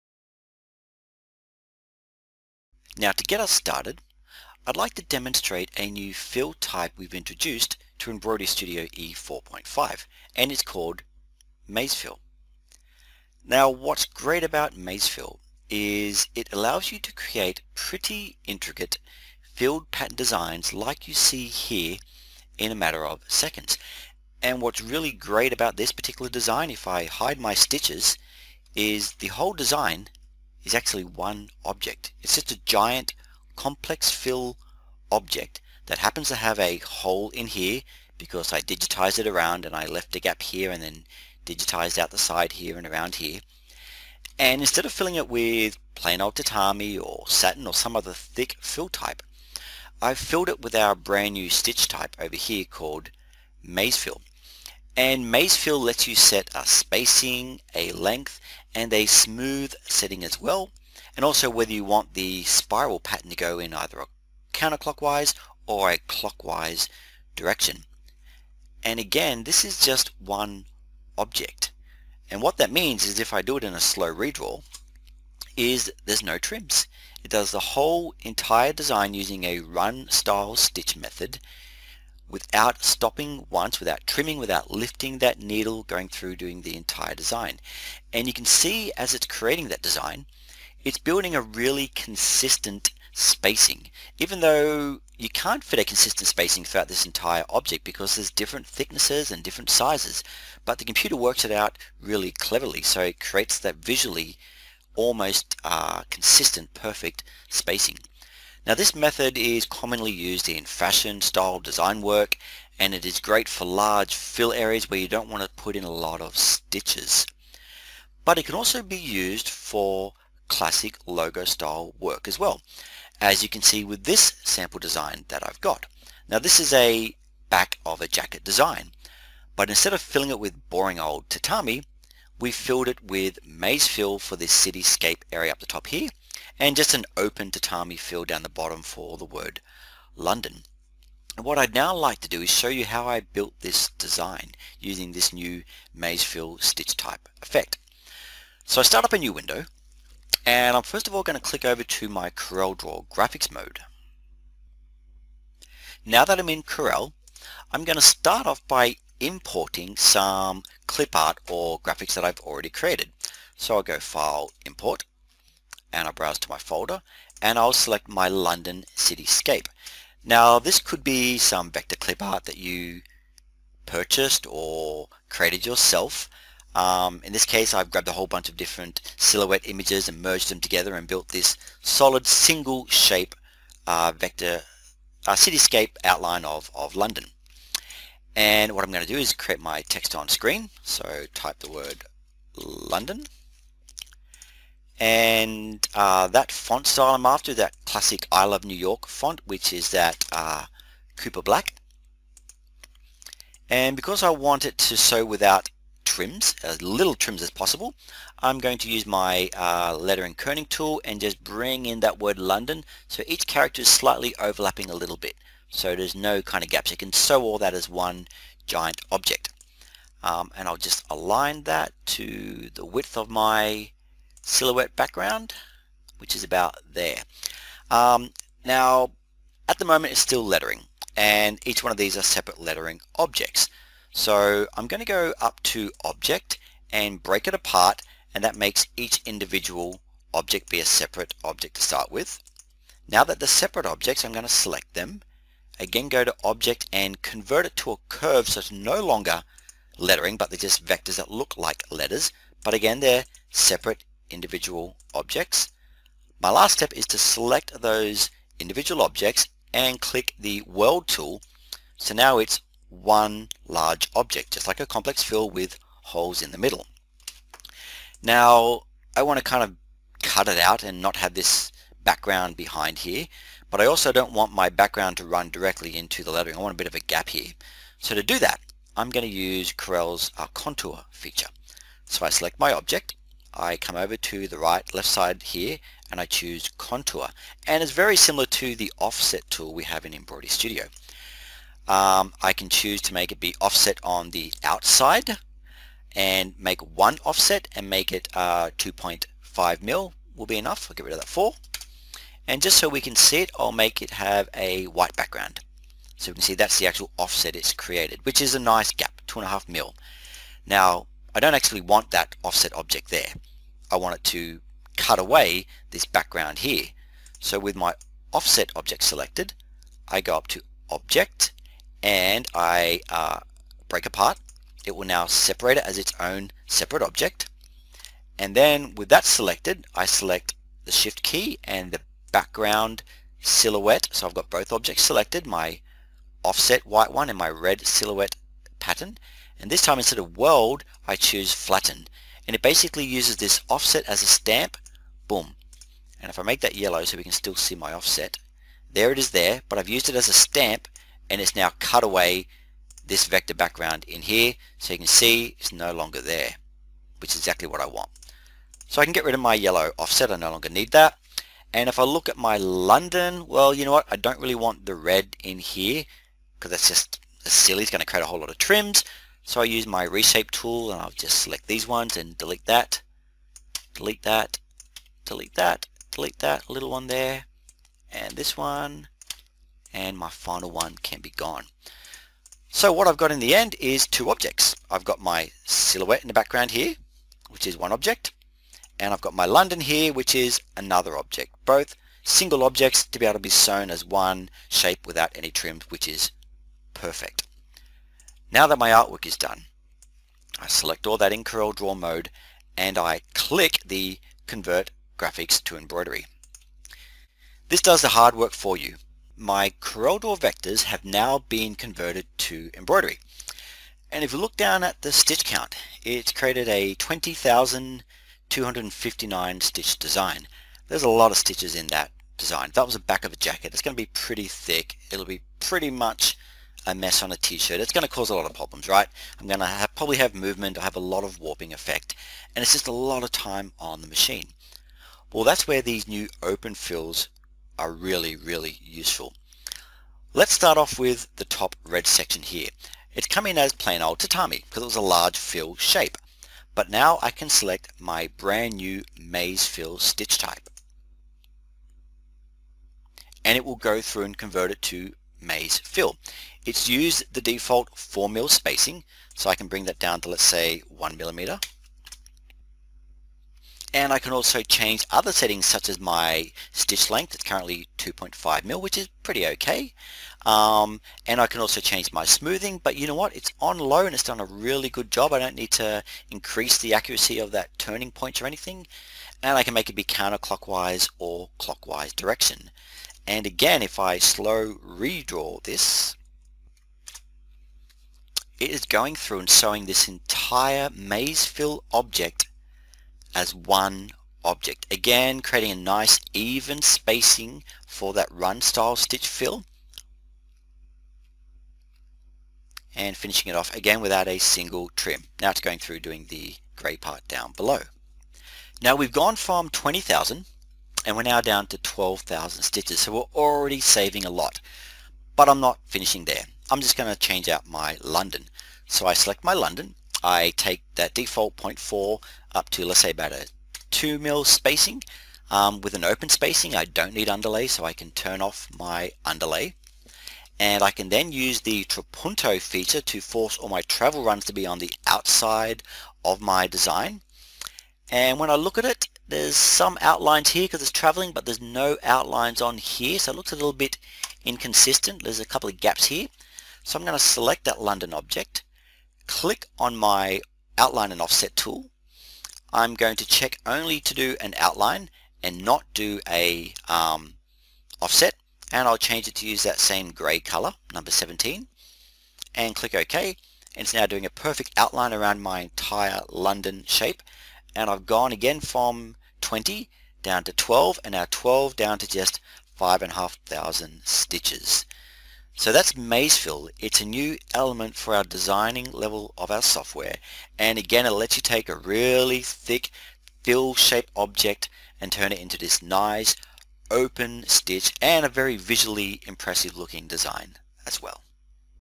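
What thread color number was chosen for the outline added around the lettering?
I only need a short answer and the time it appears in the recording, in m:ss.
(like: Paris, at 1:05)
17, at 9:21.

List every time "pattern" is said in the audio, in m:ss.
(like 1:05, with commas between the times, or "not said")
0:19, 1:02, 5:38.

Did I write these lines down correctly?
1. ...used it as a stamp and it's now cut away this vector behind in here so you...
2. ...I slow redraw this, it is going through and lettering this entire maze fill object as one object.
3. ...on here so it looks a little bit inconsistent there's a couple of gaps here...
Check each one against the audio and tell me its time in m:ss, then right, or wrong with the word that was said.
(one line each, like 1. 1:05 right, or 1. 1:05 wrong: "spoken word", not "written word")
1. 5:49 wrong: "background", not "behind"
2. 8:03 wrong: "sewing", not "lettering"
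3. 9:02 right.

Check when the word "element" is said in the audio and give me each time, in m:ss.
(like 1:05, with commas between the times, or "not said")
9:37.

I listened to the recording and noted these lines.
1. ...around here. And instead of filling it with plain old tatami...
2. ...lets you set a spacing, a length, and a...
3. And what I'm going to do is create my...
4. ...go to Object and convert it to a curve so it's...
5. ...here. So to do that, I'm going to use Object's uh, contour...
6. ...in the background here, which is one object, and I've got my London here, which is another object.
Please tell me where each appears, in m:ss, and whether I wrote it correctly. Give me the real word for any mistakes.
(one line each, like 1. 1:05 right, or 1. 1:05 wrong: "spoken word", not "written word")
1. 0:42 right
2. 0:55 right
3. 3:08 right
4. 4:06 right
5. 4:37 wrong: "Corel", not "Object"
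6. 6:26 right.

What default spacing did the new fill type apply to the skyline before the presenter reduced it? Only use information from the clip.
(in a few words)
4 mm.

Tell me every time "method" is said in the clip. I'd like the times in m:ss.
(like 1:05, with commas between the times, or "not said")
1:20, 1:48.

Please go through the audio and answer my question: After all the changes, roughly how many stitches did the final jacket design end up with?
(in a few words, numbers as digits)
5,500.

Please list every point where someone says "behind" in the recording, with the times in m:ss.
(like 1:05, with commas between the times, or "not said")
4:32.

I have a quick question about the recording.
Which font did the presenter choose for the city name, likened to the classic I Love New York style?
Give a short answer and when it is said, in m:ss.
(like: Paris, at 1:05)
Cooper Black, at 3:21.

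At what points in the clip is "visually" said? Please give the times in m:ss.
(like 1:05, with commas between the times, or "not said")
1:43, 9:48.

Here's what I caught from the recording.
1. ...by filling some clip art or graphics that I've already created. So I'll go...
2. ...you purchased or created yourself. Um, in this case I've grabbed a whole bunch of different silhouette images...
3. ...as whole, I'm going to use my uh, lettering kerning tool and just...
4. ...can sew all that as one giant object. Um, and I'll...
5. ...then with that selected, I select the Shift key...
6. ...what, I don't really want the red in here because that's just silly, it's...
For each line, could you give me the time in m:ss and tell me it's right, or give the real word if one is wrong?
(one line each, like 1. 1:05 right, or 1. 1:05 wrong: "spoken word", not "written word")
1. 2:38 wrong: "importing", not "filling"
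2. 2:52 right
3. 3:27 wrong: "possible", not "whole"
4. 3:36 right
5. 5:28 right
6. 6:03 right.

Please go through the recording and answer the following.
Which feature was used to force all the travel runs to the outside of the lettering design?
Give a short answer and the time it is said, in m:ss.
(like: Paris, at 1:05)
Trapunto, at 8:51.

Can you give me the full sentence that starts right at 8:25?
Now it's going through doing the grey part down below.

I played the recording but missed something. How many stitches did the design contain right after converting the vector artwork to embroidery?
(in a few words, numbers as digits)
20,259.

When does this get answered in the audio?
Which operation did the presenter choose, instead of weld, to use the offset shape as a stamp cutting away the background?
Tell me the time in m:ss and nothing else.
5:41.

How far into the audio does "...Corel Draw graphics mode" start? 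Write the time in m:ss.
2:32.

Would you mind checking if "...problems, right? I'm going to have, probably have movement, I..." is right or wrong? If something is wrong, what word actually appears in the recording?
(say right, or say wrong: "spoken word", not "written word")
right.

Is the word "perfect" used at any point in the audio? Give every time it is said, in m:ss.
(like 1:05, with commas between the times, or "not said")
1:46, 6:36, 9:24.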